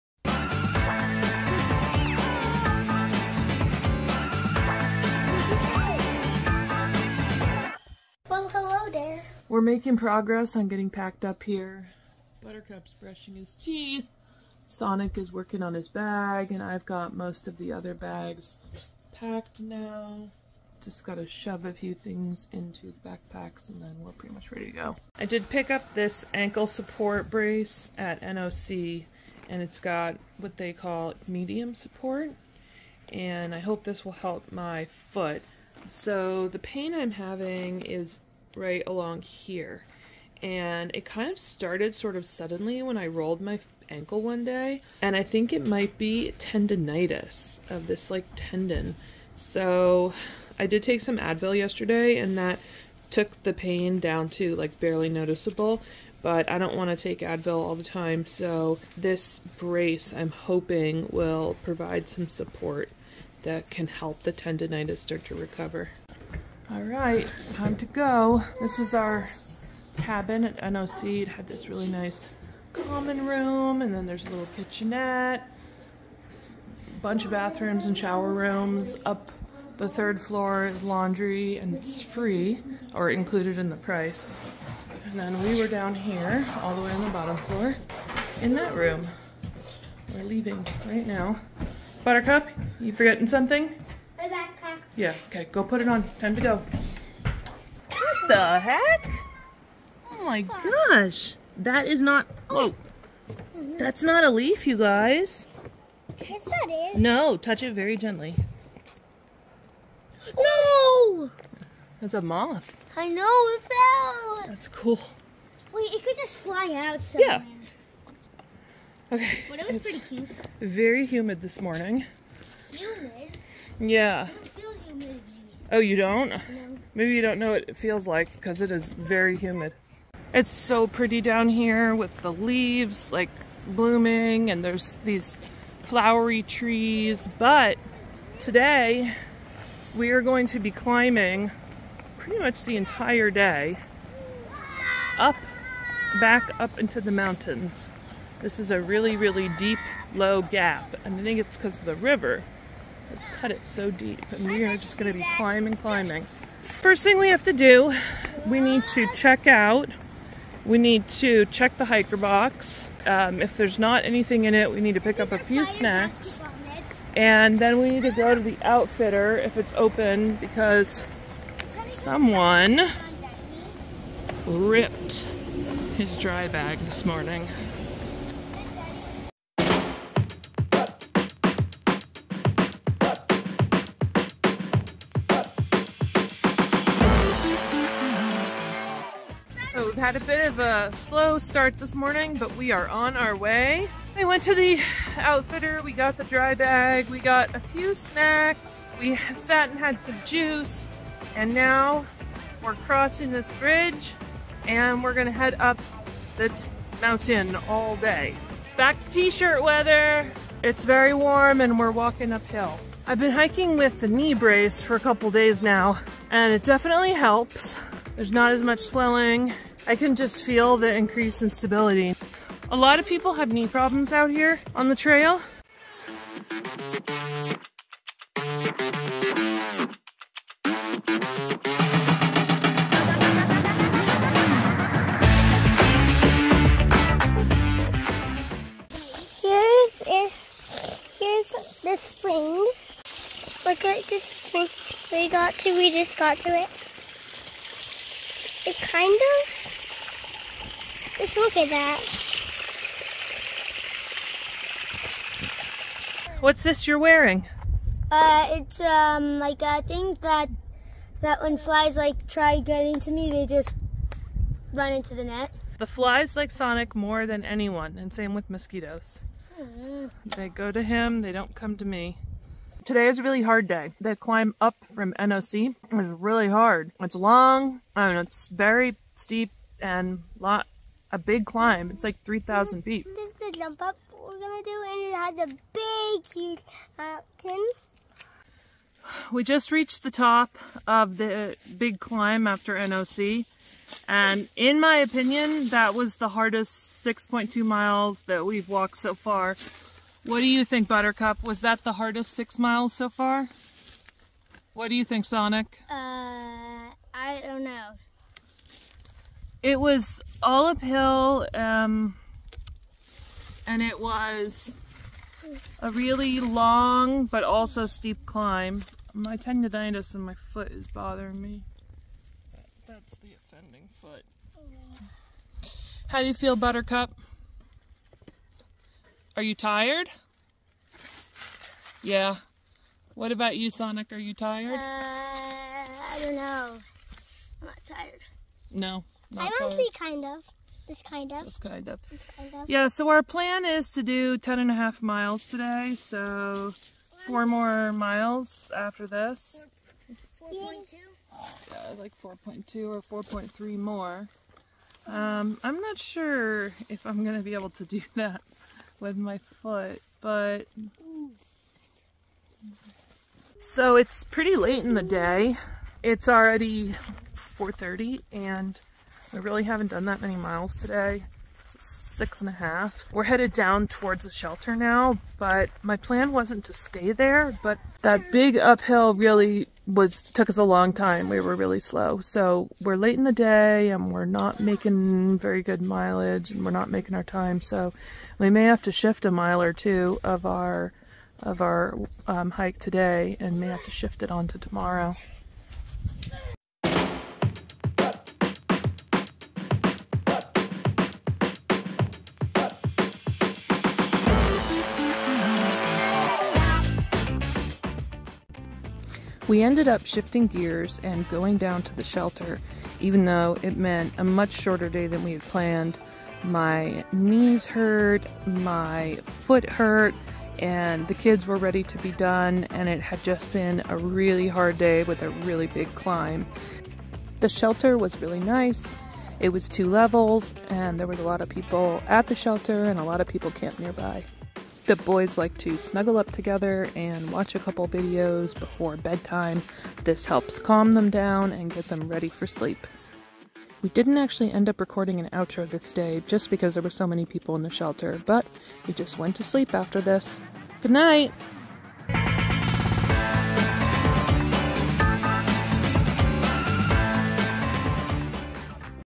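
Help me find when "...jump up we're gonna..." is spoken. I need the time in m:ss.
4:43.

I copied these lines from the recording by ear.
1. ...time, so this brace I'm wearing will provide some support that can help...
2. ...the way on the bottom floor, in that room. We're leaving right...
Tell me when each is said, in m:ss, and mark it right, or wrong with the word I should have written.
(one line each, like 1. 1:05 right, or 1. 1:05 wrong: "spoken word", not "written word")
1. 0:57 wrong: "hoping", not "wearing"
2. 1:26 right.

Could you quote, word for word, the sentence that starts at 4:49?
We just reached the top of the big climb after NOC.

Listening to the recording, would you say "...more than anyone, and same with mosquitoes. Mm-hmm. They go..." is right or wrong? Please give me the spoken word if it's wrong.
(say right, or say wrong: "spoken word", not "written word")
right.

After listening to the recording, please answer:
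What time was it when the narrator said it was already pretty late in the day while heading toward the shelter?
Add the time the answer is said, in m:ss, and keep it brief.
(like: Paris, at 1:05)
4:30, at 6:07.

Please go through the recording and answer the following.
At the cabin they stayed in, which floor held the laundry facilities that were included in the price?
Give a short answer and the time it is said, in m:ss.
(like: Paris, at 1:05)
Third floor, at 1:19.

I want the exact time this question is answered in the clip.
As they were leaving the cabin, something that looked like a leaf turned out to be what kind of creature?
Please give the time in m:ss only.
1:52.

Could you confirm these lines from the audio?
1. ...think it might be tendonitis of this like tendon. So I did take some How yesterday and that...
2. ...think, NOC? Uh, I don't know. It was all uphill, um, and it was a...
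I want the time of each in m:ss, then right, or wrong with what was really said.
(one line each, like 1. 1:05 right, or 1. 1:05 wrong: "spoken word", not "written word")
1. 0:45 wrong: "Advil", not "How"
2. 5:05 wrong: "Sonic", not "NOC".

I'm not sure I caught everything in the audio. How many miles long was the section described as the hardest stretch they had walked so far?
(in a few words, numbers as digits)
6.2 miles.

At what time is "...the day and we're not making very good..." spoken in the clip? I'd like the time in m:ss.
6:23.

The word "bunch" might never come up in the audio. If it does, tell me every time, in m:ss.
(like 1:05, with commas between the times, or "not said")
1:17.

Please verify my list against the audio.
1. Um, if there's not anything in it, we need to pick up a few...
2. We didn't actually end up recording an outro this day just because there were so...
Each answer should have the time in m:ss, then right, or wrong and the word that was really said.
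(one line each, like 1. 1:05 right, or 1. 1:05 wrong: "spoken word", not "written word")
1. 2:43 right
2. 7:23 right.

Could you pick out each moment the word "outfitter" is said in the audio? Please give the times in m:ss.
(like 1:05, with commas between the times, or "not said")
2:48, 3:15.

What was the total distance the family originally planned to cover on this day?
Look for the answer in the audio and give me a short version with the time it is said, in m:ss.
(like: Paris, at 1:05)
10.5 miles, at 5:44.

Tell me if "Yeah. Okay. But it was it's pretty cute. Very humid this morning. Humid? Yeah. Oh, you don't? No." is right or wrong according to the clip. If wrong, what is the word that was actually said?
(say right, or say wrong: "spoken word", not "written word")
right.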